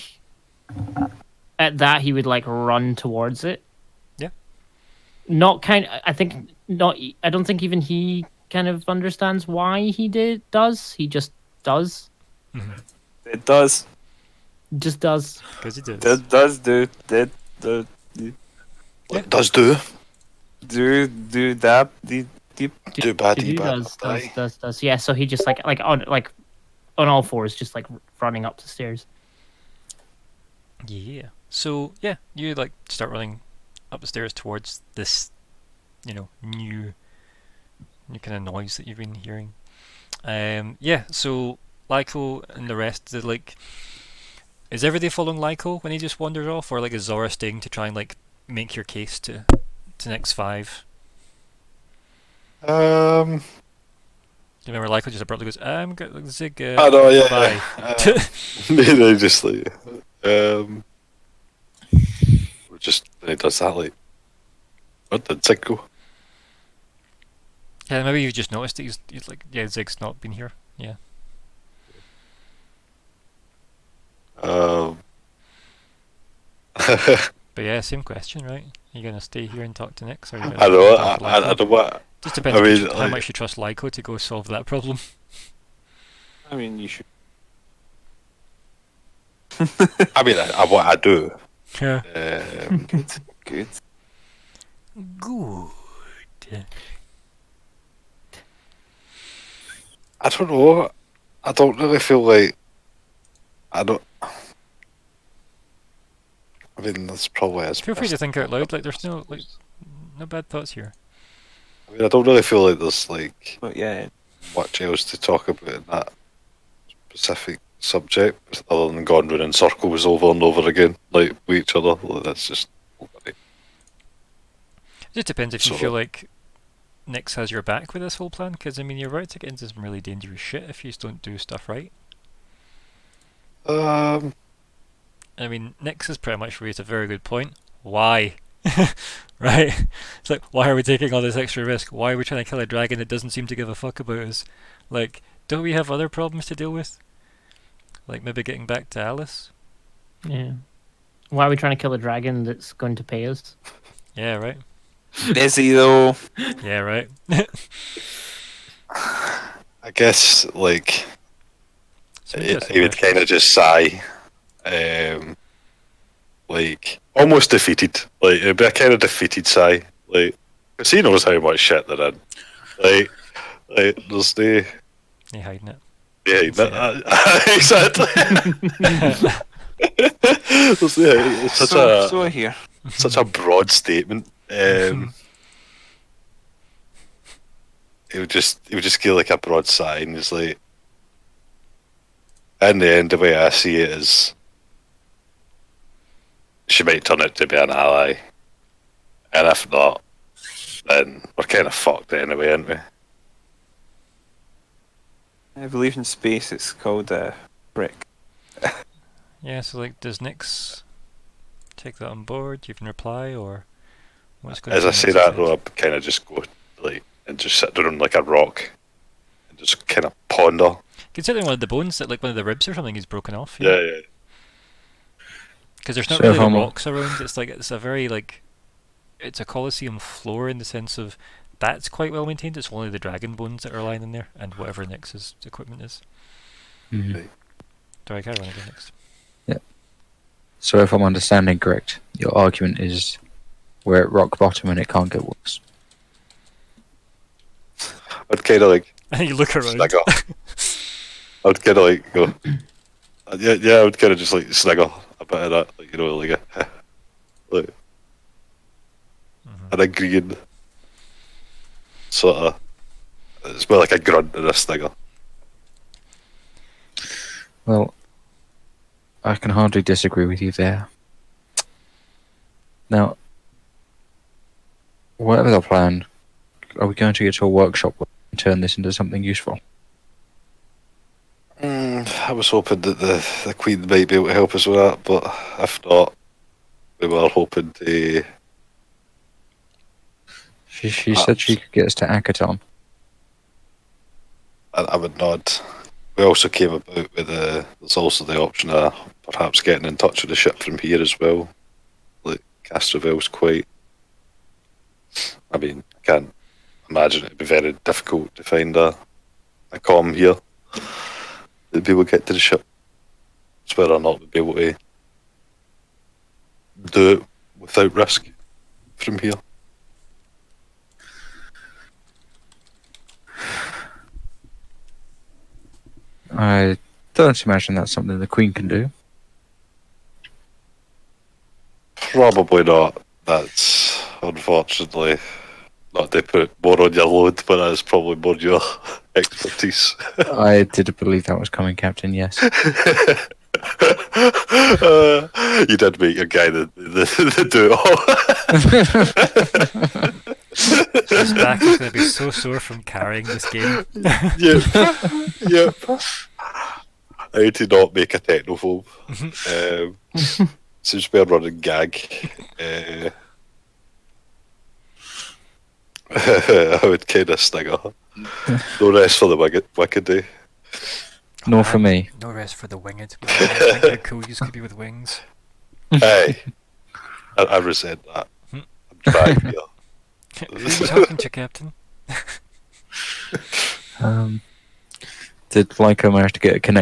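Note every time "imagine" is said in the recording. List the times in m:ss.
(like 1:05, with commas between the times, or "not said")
5:06, 5:27.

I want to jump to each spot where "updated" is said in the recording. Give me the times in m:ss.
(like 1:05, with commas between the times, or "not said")
not said.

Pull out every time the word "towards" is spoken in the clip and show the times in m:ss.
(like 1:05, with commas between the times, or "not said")
0:02, 0:34.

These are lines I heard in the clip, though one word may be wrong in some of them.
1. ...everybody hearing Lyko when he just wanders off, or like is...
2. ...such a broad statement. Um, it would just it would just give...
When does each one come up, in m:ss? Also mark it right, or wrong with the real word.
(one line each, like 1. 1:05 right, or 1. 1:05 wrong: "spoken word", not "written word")
1. 0:44 wrong: "following", not "hearing"
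2. 3:02 right.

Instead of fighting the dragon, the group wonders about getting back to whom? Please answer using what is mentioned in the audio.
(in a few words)
Alice.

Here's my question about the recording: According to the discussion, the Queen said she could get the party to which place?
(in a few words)
Akiton.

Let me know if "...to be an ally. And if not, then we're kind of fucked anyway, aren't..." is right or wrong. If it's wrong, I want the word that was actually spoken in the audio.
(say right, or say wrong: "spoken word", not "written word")
right.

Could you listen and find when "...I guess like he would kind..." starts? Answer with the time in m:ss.
2:38.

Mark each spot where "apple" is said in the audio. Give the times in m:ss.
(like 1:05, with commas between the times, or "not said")
not said.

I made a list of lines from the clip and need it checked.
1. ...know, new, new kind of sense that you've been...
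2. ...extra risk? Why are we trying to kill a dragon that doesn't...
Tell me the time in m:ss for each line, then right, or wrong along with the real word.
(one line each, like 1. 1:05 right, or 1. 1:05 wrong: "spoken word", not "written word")
1. 0:36 wrong: "noise", not "sense"
2. 2:21 right.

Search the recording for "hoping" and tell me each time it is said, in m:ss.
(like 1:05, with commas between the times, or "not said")
4:42, 4:47.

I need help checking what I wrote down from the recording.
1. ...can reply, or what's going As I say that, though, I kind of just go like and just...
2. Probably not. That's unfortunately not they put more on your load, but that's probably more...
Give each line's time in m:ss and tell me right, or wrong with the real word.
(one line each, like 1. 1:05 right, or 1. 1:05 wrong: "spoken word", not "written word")
1. 3:32 right
2. 5:31 right.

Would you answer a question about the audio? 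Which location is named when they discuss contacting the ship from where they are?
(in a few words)
Castrovel.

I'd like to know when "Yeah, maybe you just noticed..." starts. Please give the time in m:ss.
1:07.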